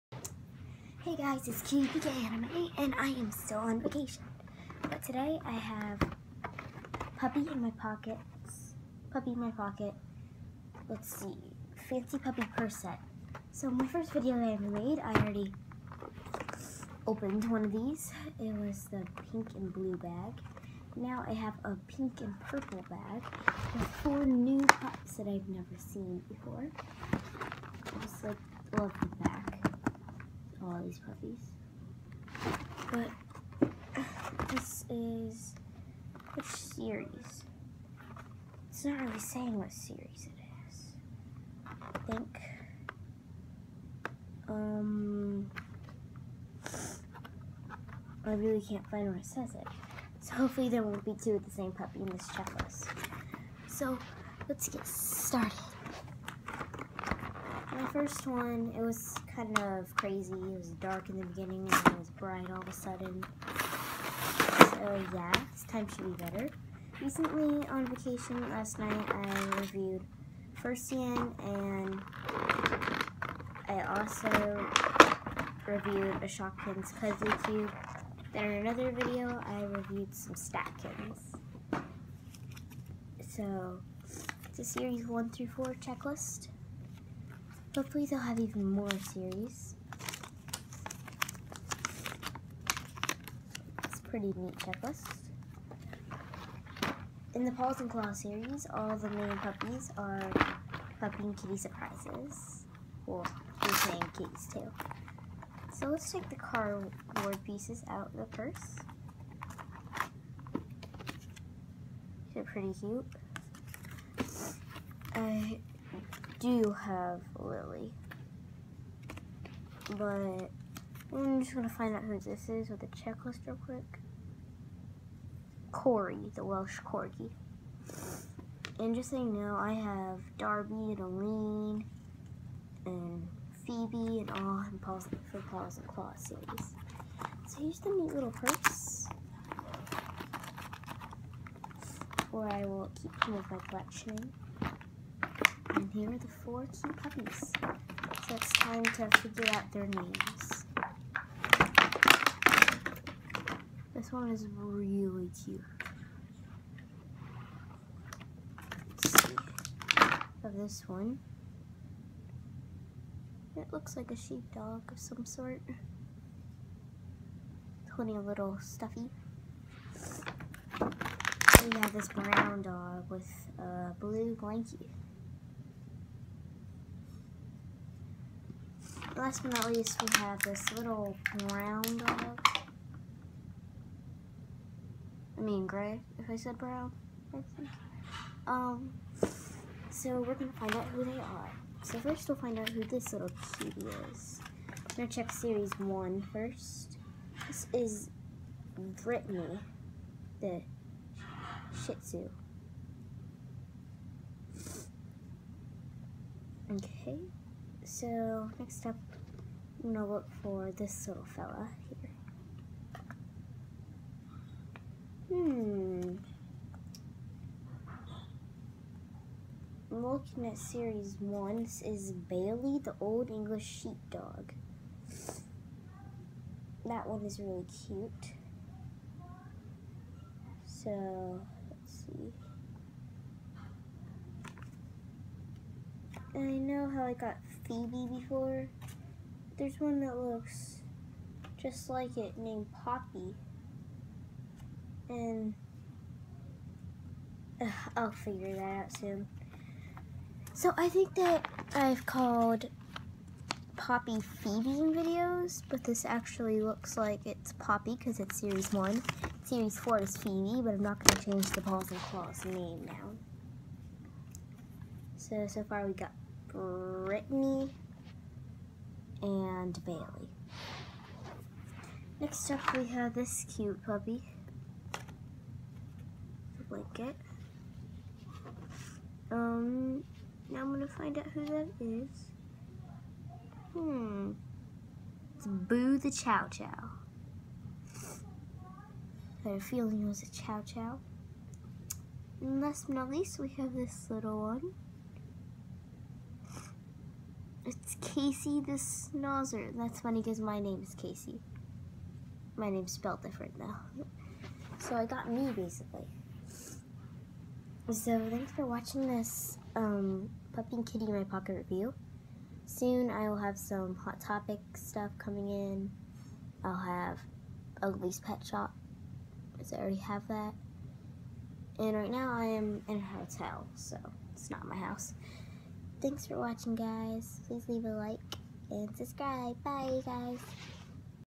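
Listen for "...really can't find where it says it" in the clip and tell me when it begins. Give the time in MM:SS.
00:48.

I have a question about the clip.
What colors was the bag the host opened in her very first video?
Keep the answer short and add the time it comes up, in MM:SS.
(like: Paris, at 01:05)
Pink and blue, at 00:19.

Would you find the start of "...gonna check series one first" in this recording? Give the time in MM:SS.
03:14.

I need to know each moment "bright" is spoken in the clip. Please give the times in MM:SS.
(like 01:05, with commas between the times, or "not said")
01:02.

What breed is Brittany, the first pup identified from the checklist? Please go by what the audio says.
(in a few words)
Shih Tzu.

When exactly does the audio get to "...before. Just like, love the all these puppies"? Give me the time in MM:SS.
00:26.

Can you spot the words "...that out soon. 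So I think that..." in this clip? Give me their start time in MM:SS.
04:08.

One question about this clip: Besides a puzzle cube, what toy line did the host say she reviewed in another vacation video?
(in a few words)
Statkins.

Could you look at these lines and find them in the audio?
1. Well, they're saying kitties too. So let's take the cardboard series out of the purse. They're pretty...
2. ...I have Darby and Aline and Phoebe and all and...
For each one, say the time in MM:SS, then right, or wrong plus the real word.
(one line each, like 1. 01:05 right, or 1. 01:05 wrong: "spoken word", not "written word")
1. 01:43 wrong: "pieces", not "series"
2. 02:09 right.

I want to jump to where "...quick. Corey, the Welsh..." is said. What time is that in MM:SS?
02:03.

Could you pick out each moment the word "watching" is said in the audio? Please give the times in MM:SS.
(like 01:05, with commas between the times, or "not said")
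05:08, 05:26.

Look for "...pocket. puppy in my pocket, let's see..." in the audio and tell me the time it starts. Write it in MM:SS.
00:07.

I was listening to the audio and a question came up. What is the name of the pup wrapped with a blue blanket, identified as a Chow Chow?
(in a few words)
Boo.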